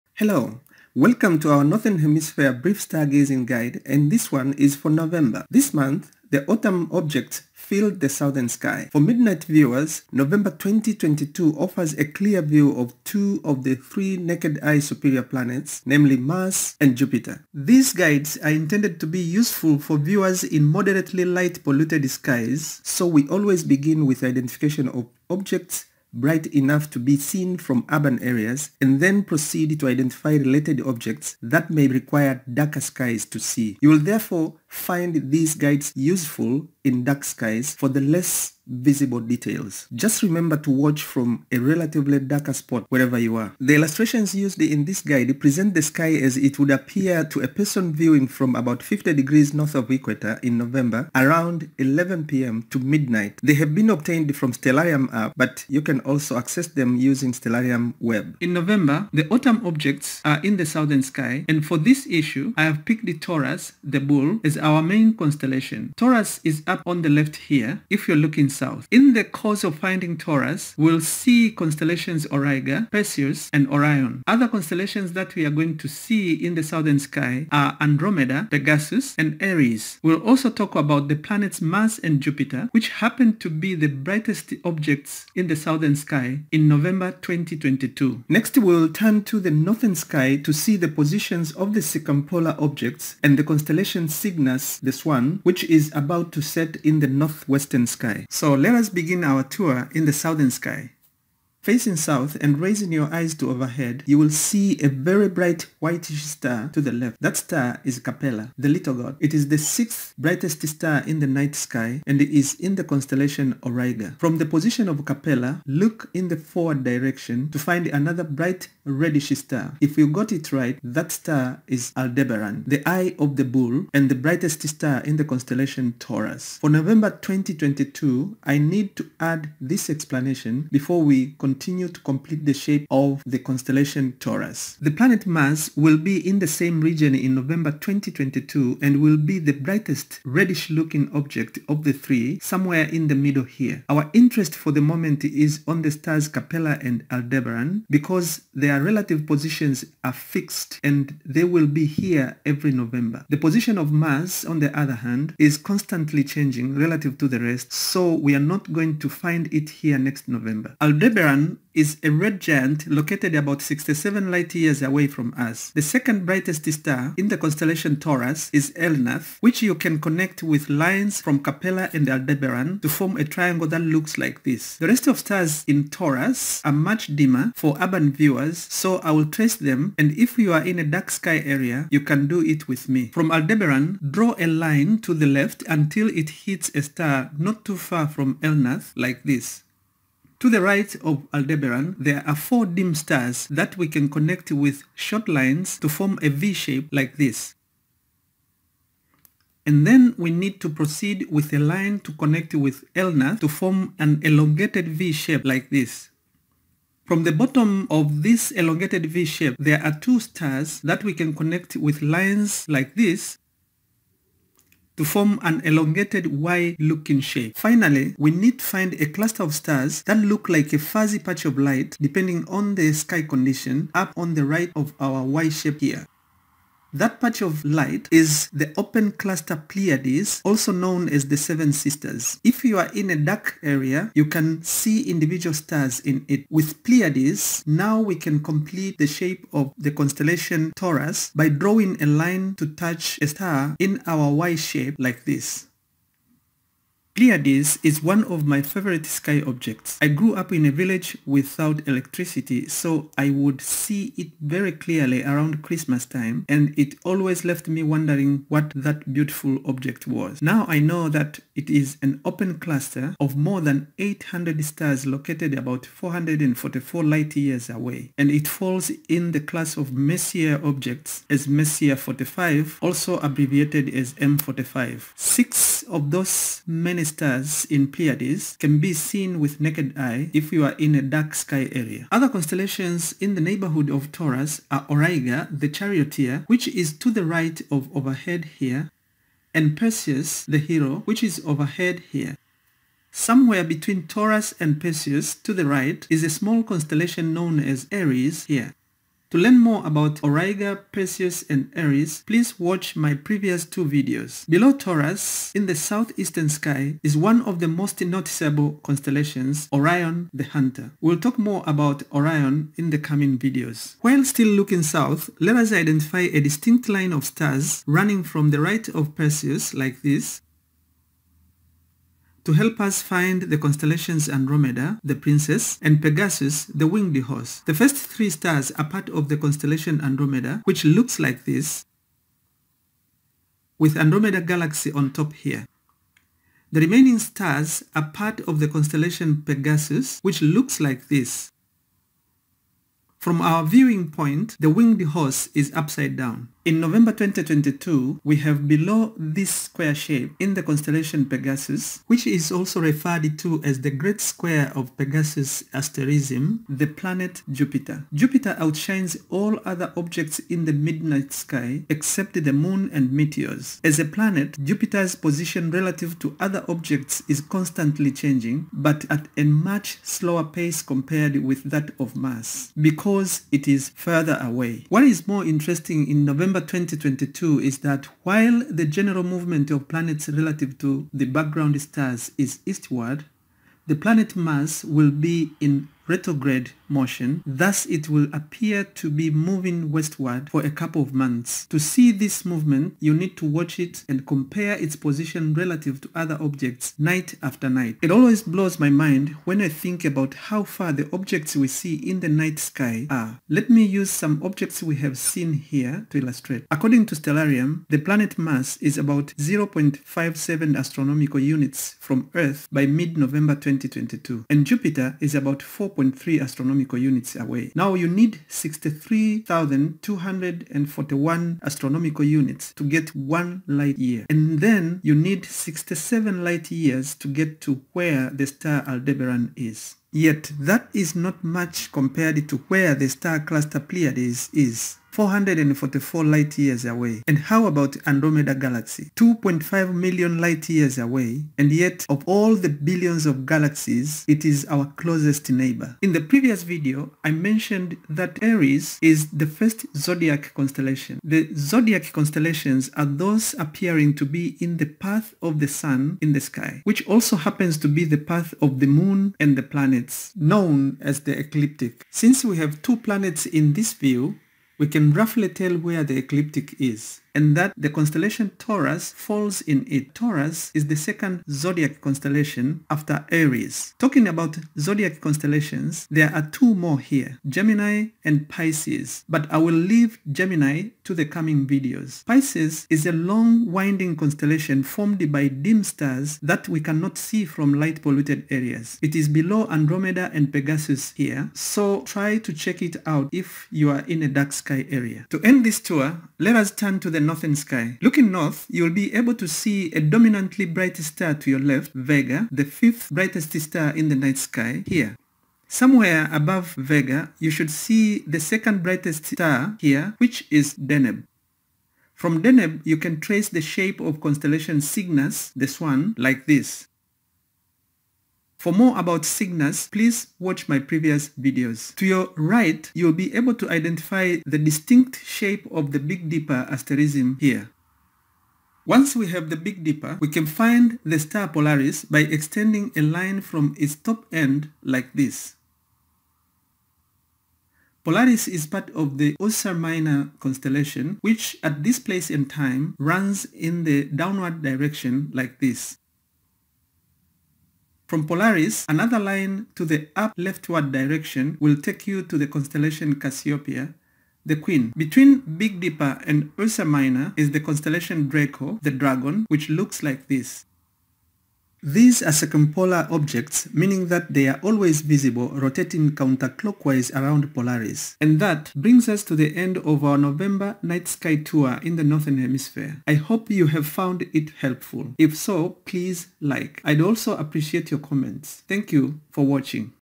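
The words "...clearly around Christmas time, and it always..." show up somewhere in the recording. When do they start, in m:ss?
4:14.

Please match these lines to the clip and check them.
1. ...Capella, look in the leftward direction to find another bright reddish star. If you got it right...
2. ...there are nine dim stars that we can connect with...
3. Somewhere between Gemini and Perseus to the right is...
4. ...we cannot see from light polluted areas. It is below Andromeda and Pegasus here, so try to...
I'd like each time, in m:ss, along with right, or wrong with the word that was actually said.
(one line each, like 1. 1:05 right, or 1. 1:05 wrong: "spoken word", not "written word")
1. 1:55 wrong: "forward", not "leftward"
2. 3:11 wrong: "four", not "nine"
3. 4:53 wrong: "Taurus", not "Gemini"
4. 8:06 right.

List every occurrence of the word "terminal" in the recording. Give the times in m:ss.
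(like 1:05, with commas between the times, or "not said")
not said.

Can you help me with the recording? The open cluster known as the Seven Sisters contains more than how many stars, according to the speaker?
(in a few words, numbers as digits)
800.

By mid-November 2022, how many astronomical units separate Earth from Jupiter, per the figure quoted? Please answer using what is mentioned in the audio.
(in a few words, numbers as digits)
4.3.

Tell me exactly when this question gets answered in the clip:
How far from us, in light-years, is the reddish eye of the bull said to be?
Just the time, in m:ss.
2:43.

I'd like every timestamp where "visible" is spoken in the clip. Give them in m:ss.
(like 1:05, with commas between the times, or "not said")
0:38, 9:25.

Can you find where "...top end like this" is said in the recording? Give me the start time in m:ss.
8:53.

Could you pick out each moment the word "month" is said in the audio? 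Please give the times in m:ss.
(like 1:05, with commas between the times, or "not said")
0:05, 6:31.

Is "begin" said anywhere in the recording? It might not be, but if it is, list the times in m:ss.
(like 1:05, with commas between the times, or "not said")
0:23, 1:38.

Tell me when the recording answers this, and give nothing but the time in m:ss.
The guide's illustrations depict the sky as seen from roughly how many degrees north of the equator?
0:48.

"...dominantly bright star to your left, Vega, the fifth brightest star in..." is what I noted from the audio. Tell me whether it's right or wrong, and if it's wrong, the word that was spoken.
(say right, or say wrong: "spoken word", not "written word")
right.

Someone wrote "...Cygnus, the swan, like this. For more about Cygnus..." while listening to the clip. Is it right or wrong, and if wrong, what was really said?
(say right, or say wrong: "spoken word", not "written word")
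right.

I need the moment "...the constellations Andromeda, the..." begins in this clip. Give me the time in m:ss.
5:23.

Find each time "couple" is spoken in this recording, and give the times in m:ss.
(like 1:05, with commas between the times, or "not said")
6:30.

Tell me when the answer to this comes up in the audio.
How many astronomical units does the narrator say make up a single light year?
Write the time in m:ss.
6:58.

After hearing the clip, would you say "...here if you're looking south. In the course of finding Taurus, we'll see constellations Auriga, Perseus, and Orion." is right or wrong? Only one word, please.
right.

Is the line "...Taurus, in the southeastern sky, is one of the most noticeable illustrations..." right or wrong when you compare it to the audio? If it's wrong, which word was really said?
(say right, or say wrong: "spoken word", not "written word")
wrong: "constellations", not "illustrations".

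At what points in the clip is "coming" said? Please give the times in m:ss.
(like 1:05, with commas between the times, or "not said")
5:12, 8:01.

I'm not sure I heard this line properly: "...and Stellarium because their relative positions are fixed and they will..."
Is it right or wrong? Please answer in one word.
wrong.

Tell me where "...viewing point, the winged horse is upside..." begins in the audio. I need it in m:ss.
5:43.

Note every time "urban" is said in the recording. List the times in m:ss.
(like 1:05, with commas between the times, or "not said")
0:27, 2:57.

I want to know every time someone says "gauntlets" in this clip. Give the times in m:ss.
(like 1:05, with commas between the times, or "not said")
not said.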